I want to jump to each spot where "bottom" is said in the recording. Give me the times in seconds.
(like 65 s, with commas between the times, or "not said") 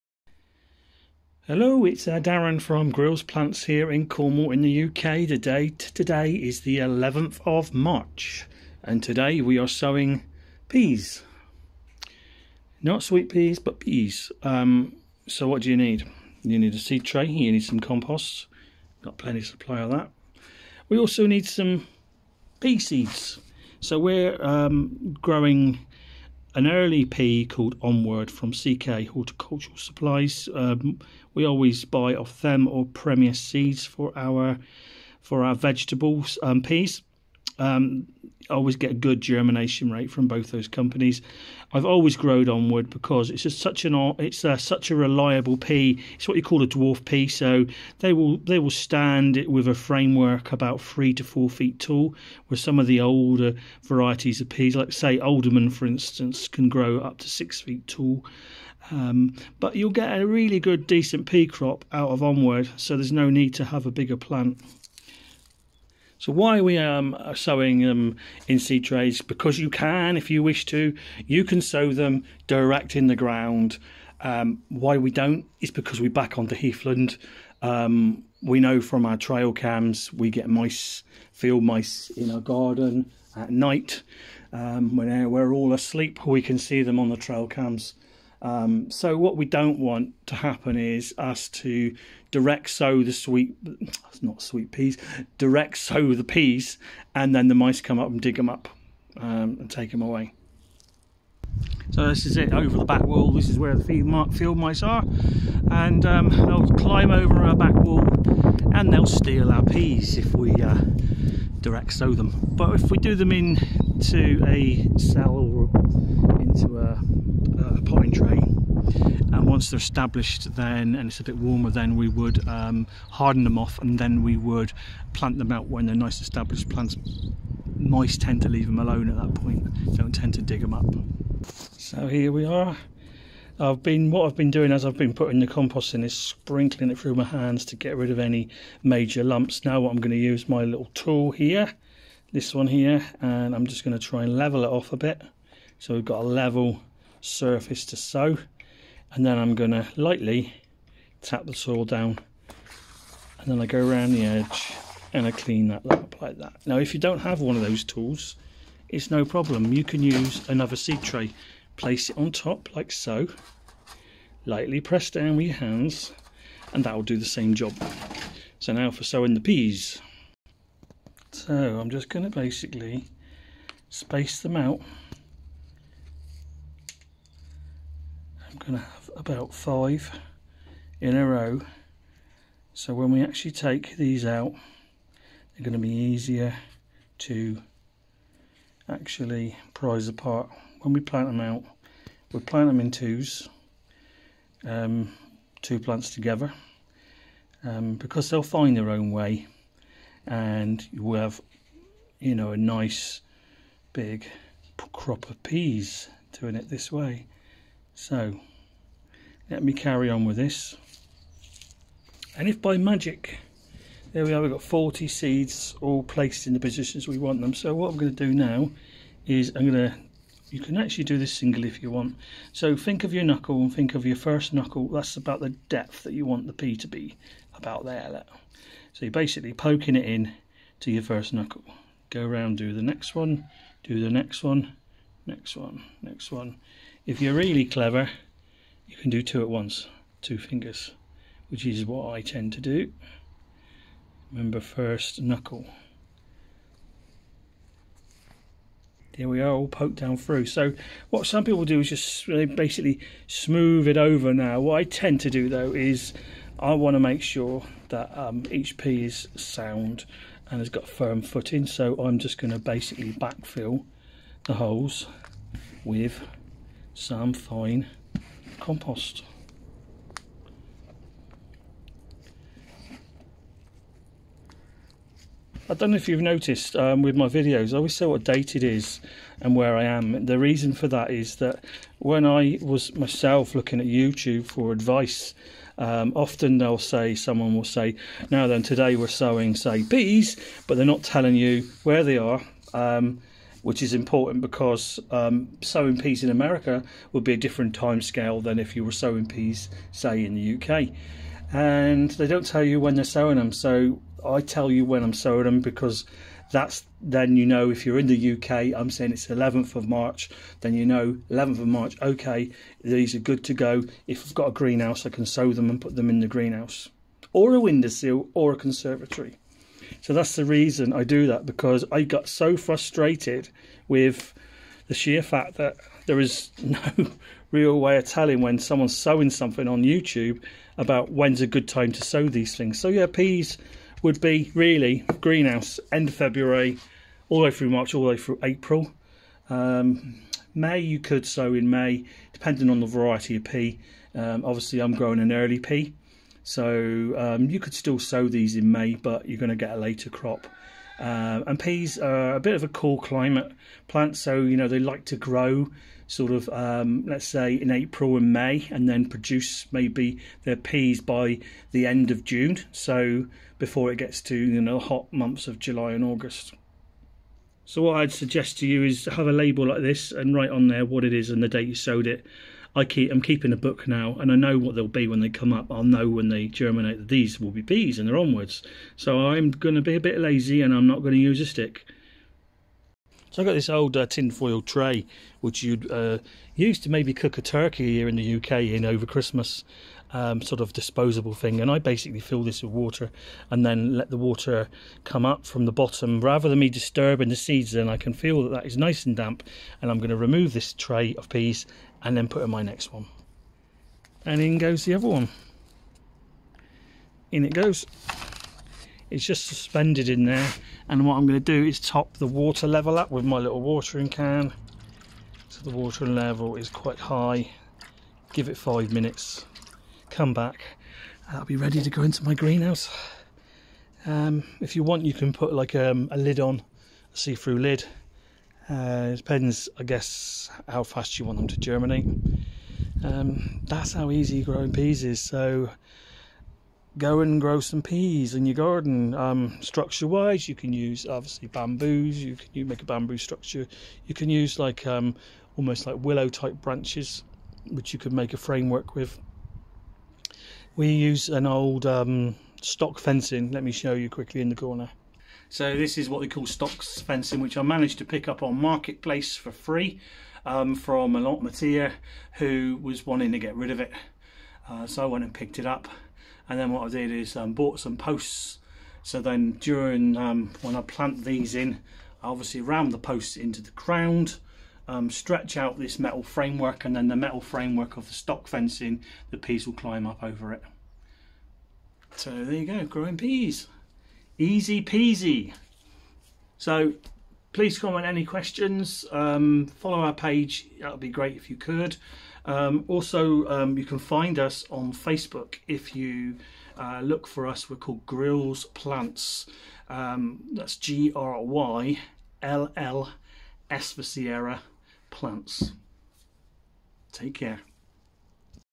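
395 s.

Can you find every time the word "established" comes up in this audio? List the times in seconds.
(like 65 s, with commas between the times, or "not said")
119 s, 126 s.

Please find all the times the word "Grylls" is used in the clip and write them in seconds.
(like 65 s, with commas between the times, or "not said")
2 s, 498 s.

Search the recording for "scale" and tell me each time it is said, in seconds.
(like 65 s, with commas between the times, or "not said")
298 s.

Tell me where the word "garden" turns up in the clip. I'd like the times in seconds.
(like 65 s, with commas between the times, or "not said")
82 s, 438 s.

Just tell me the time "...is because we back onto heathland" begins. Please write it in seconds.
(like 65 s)
75 s.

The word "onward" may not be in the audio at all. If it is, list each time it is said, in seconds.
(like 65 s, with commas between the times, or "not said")
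27 s, 42 s, 62 s, 378 s.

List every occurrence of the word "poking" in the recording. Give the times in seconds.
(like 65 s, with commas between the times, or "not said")
229 s.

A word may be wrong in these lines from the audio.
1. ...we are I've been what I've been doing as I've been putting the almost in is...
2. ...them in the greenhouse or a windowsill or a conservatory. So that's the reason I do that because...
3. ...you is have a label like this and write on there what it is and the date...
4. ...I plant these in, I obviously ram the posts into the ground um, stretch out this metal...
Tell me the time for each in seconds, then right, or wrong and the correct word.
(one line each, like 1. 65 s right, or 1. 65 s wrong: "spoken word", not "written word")
1. 132 s wrong: "compost", not "almost"
2. 315 s right
3. 368 s right
4. 470 s right.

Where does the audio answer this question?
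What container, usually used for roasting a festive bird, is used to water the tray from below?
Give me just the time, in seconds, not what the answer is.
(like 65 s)
384 s.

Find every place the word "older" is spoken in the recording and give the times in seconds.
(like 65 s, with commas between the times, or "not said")
52 s.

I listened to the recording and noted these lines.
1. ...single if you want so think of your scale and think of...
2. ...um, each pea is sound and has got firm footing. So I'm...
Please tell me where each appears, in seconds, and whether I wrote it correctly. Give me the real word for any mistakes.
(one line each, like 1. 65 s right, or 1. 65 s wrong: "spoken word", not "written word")
1. 221 s wrong: "knuckle", not "scale"
2. 258 s right.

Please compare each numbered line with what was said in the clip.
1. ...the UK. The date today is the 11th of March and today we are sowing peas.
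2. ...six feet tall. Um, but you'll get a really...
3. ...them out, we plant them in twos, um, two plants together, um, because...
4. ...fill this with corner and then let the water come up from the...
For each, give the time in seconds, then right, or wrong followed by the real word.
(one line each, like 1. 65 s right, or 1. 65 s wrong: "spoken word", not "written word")
1. 4 s right
2. 57 s right
3. 191 s right
4. 392 s wrong: "water", not "corner".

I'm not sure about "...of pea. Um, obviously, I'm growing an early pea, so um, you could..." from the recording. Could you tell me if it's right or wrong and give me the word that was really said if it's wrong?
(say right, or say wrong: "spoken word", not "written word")
right.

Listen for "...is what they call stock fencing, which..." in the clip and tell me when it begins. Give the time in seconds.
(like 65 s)
455 s.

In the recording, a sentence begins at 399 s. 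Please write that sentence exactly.
And I'm going to remove this tray of peas and then put in my next one.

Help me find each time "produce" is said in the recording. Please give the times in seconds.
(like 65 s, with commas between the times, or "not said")
359 s.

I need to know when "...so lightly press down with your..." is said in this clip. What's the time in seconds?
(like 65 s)
162 s.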